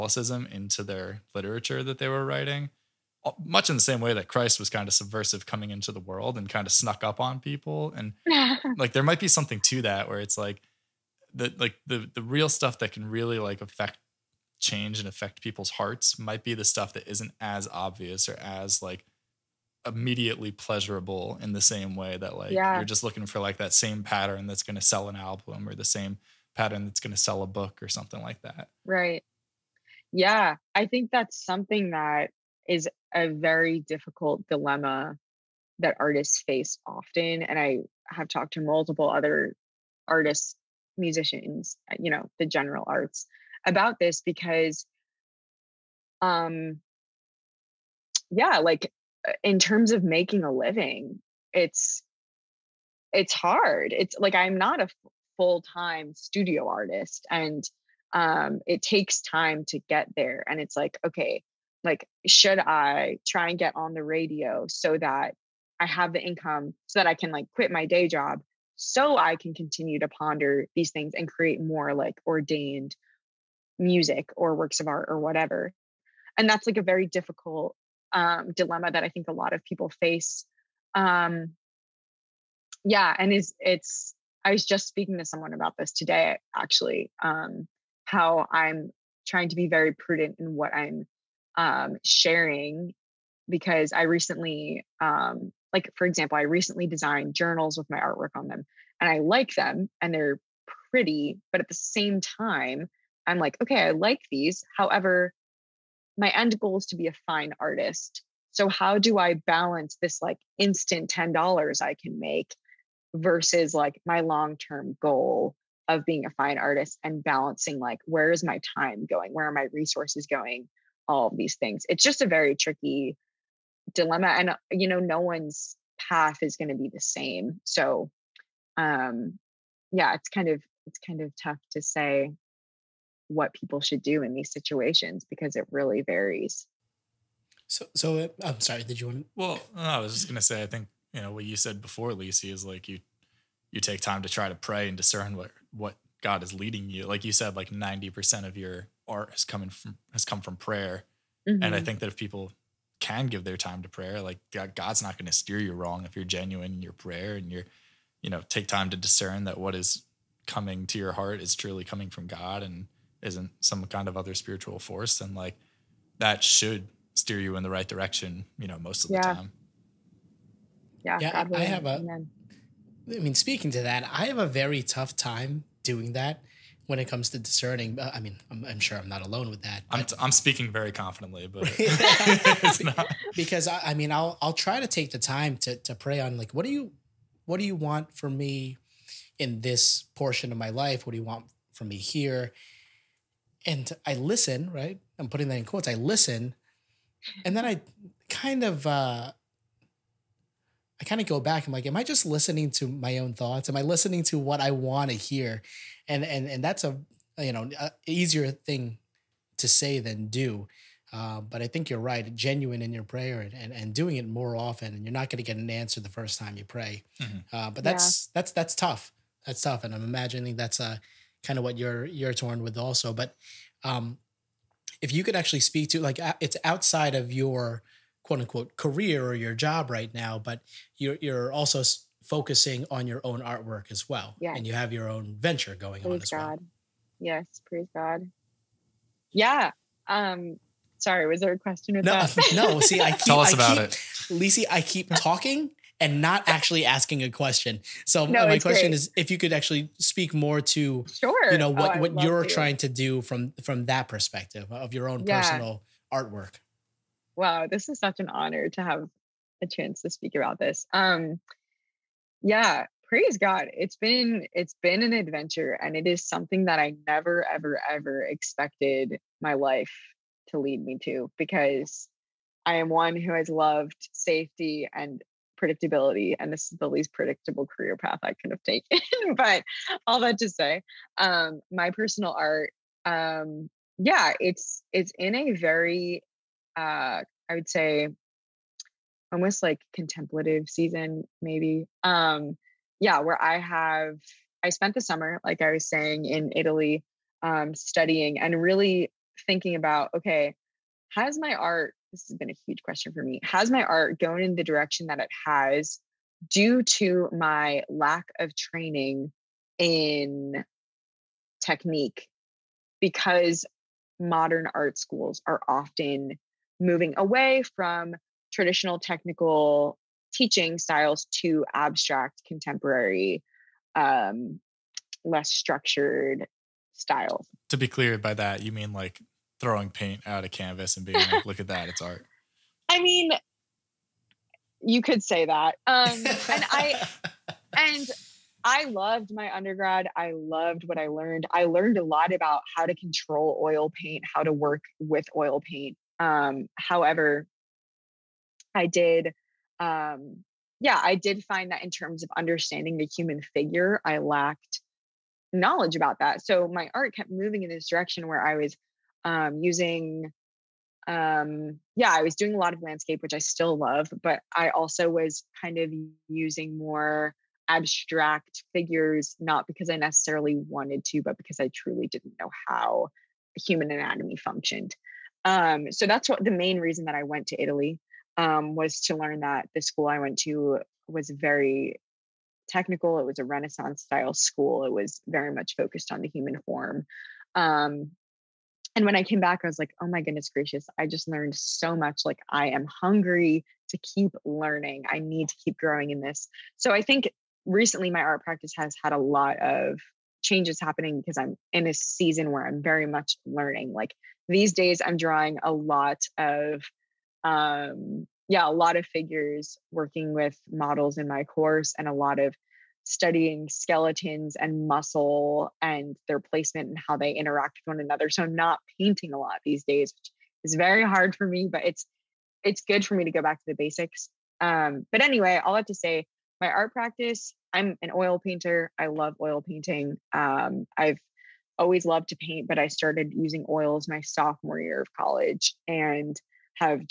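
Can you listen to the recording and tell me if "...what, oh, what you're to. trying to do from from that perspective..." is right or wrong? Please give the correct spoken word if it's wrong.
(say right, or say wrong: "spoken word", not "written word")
right.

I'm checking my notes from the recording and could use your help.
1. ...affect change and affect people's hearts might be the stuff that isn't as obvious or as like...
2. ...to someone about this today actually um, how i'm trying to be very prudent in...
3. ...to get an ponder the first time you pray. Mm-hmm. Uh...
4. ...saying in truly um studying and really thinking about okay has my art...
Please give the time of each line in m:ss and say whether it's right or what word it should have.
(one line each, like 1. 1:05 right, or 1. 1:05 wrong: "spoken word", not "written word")
1. 0:13 right
2. 1:25 right
3. 3:35 wrong: "answer", not "ponder"
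4. 4:55 wrong: "italy", not "truly".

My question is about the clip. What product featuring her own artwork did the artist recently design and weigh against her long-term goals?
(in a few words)
Journals.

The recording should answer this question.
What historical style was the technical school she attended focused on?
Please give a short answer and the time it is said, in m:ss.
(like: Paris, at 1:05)
Renaissance, at 6:23.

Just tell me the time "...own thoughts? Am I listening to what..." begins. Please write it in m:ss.
3:23.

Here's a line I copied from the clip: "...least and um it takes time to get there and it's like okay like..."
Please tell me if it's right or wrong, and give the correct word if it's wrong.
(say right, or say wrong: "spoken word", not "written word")
wrong: "artist", not "least".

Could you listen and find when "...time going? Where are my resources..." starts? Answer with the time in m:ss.
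1:58.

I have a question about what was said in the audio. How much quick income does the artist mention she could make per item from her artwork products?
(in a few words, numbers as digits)
$10.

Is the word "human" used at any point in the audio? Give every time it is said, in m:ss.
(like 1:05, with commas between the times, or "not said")
5:53, 6:13, 6:26.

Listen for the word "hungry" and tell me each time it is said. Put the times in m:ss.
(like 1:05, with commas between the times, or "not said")
6:33.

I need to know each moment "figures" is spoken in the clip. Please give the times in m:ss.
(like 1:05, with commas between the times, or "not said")
5:53, 6:08, 6:49.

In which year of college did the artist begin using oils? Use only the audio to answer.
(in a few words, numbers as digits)
Sophomore year.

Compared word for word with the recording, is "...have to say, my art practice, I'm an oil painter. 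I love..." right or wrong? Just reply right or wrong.
right.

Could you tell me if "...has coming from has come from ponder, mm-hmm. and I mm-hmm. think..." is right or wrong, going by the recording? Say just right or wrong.
wrong.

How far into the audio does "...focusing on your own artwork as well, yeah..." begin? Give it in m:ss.
3:52.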